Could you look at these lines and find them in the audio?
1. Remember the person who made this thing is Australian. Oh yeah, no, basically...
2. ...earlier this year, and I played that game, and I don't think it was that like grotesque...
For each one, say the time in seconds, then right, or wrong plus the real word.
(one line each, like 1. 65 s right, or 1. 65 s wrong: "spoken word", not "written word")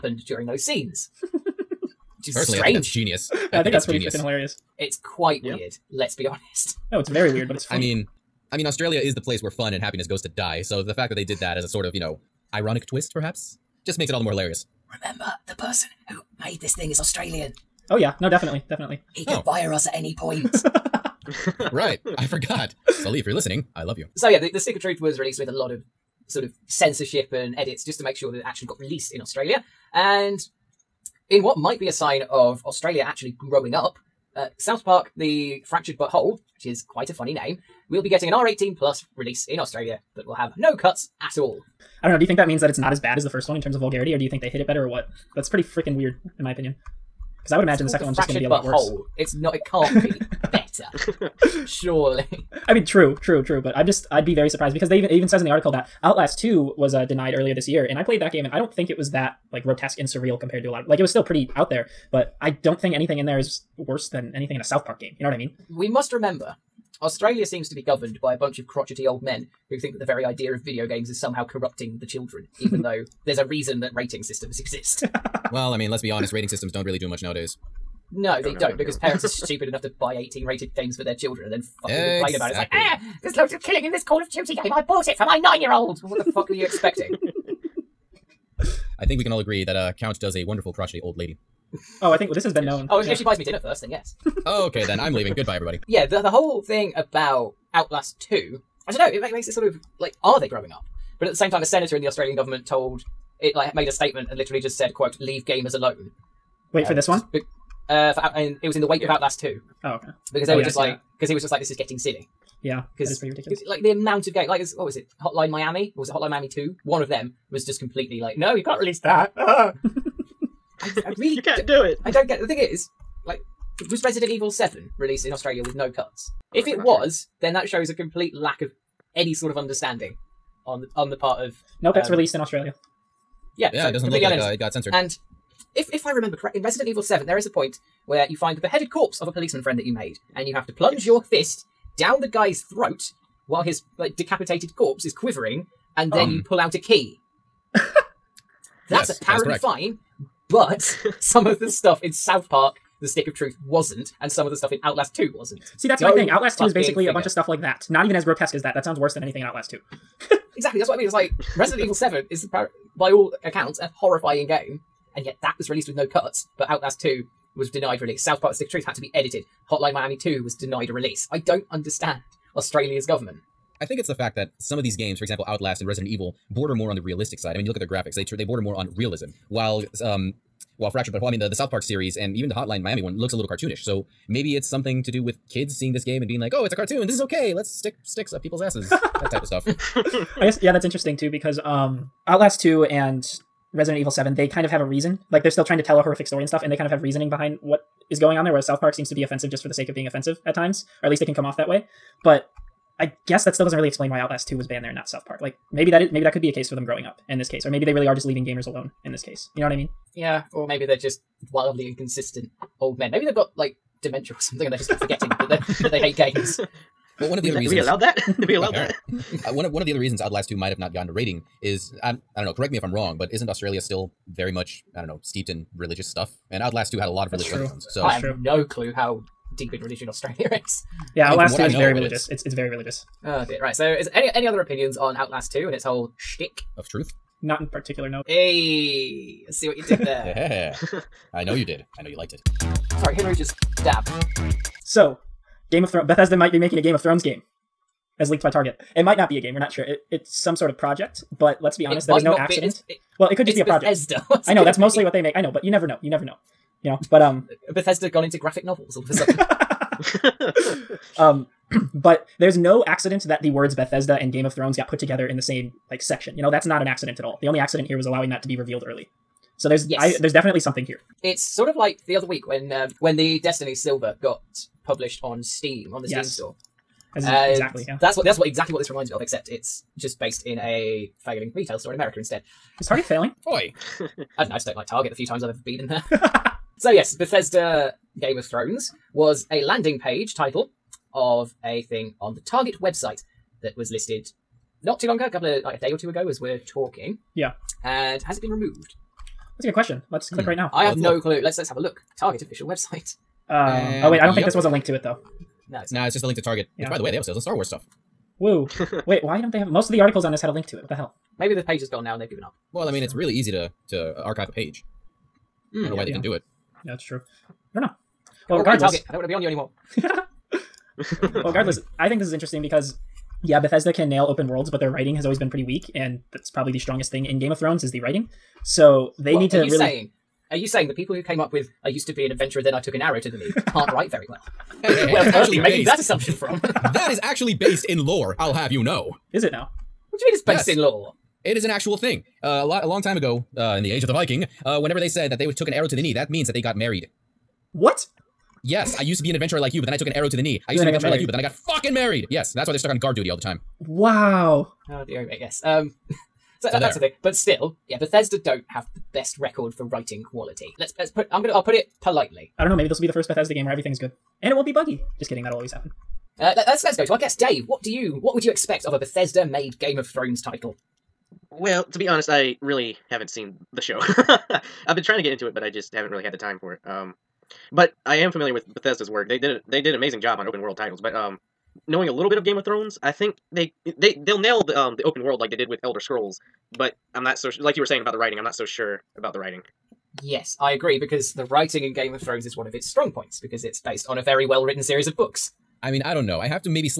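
1. 14 s wrong: "definitely", not "basically"
2. 57 s right.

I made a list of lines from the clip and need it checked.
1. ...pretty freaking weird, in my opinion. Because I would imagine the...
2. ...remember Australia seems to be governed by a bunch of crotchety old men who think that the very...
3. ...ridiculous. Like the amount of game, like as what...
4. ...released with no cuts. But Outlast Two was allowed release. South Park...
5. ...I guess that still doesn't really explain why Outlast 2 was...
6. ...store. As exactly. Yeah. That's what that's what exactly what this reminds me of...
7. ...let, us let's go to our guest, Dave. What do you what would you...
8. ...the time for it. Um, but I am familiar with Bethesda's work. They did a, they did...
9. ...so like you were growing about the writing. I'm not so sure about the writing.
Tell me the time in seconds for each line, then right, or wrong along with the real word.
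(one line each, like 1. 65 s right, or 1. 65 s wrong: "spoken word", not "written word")
1. 45 s right
2. 66 s right
3. 113 s right
4. 165 s wrong: "denied", not "allowed"
5. 202 s right
6. 276 s right
7. 366 s right
8. 376 s right
9. 387 s wrong: "saying", not "growing".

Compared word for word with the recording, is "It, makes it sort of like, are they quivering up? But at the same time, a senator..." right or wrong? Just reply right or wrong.
wrong.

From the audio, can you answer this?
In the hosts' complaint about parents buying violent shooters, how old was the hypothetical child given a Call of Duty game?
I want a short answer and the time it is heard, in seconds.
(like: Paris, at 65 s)
9, at 85 s.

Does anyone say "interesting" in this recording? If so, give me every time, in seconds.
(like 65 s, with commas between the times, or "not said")
190 s, 322 s.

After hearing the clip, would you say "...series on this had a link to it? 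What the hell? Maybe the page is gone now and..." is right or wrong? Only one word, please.
wrong.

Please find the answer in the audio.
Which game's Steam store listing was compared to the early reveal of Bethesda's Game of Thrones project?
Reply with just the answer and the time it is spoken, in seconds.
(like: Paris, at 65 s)
Destiny, at 273 s.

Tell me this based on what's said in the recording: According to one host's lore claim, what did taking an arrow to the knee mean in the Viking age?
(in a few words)
got married.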